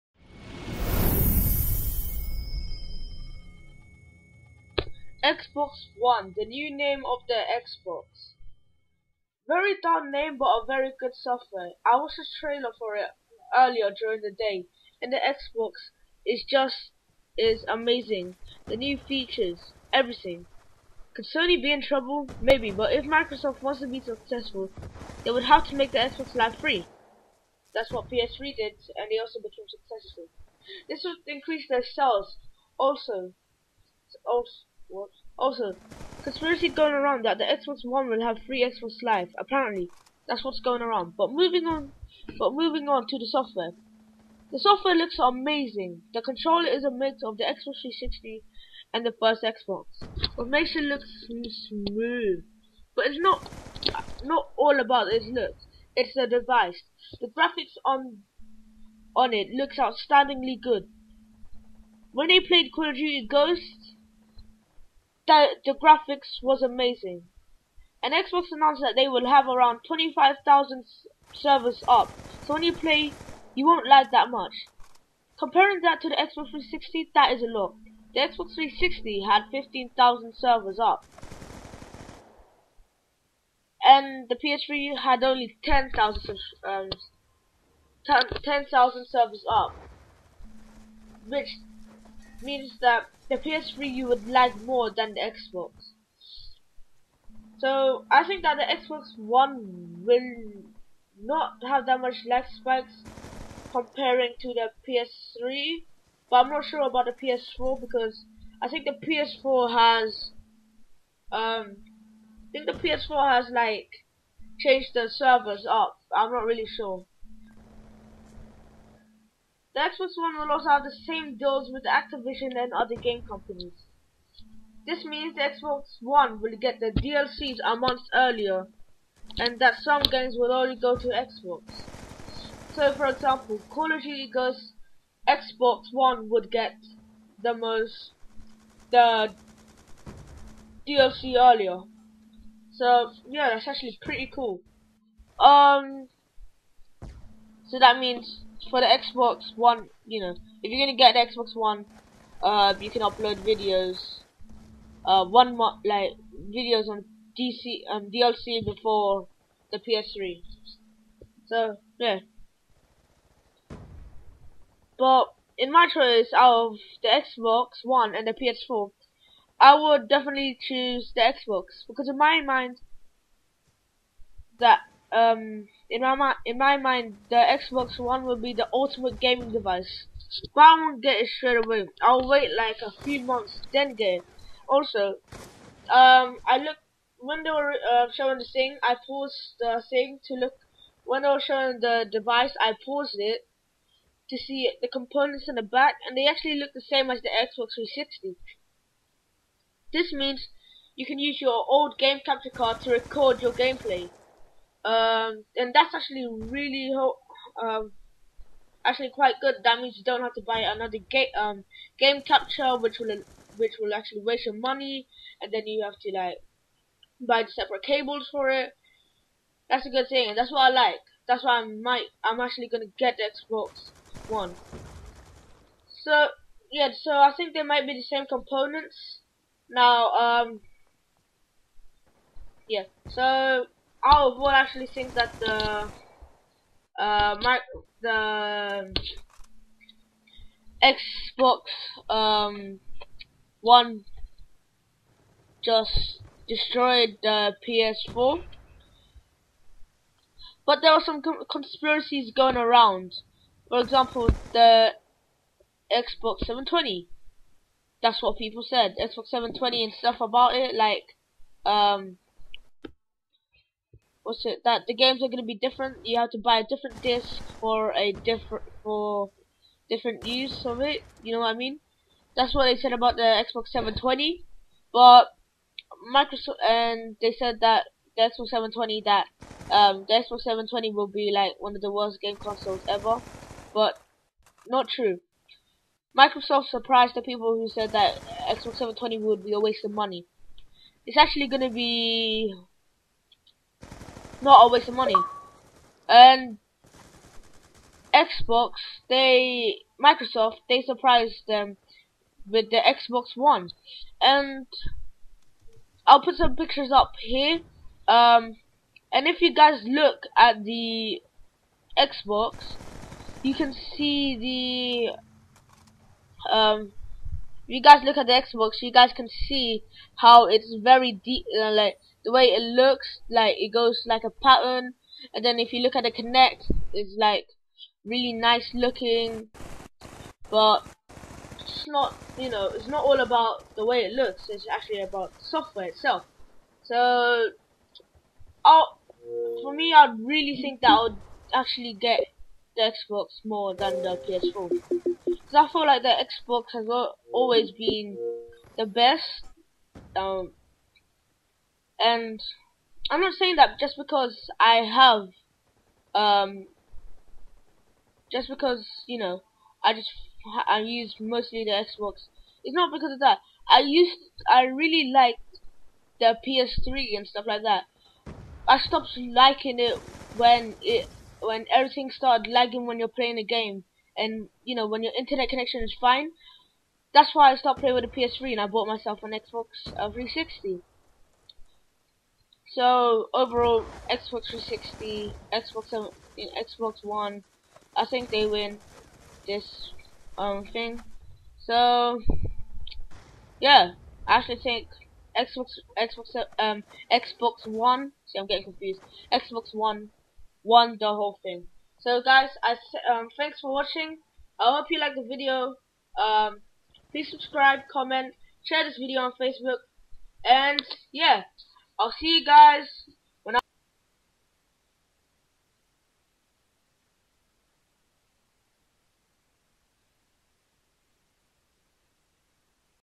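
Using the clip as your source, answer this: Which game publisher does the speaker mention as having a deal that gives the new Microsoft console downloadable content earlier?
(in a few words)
Activision.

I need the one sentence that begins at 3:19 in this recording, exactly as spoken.
This means you can use your old game capture card to record your gameplay.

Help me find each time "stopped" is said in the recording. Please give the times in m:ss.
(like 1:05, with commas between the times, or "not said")
6:08, 6:17.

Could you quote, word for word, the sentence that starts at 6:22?
So overall, Xbox 360, Xbox 7, Xbox One, I think they win this um thing.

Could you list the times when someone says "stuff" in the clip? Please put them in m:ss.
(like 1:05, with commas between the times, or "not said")
4:19, 6:07.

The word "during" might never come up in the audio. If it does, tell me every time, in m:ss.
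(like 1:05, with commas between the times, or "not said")
0:13.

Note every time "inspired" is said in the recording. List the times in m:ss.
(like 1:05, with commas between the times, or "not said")
not said.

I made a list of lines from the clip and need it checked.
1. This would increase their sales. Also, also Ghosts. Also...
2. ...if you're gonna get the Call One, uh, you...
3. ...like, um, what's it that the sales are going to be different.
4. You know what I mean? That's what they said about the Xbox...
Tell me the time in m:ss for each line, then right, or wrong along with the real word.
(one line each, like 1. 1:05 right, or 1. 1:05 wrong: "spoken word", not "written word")
1. 0:30 wrong: "Whoops", not "Ghosts"
2. 2:30 wrong: "Xbox", not "Call"
3. 4:20 wrong: "games", not "sales"
4. 4:31 right.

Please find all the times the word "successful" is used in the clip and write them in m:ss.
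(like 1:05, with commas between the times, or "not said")
0:24, 0:29.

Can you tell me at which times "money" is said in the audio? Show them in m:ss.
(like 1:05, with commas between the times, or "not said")
3:34, 4:49, 4:54.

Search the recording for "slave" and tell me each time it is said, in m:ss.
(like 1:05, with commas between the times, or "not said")
not said.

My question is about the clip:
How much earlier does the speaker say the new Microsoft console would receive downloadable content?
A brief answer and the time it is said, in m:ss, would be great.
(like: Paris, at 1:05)
a month, at 2:07.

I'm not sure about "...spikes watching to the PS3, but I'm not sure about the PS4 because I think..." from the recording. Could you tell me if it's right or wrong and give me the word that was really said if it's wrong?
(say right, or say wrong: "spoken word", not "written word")
wrong: "comparing", not "watching".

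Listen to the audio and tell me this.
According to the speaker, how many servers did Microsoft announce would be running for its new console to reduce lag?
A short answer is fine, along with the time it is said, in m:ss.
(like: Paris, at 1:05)
25,000, at 1:09.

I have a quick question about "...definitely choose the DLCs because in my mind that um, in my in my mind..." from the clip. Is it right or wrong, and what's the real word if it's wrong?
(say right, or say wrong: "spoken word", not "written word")
wrong: "Xbox", not "DLCs".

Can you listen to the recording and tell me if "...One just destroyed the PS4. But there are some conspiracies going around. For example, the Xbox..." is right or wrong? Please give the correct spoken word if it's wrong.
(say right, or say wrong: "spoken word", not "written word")
right.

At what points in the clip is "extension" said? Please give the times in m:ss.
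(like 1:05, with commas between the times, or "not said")
not said.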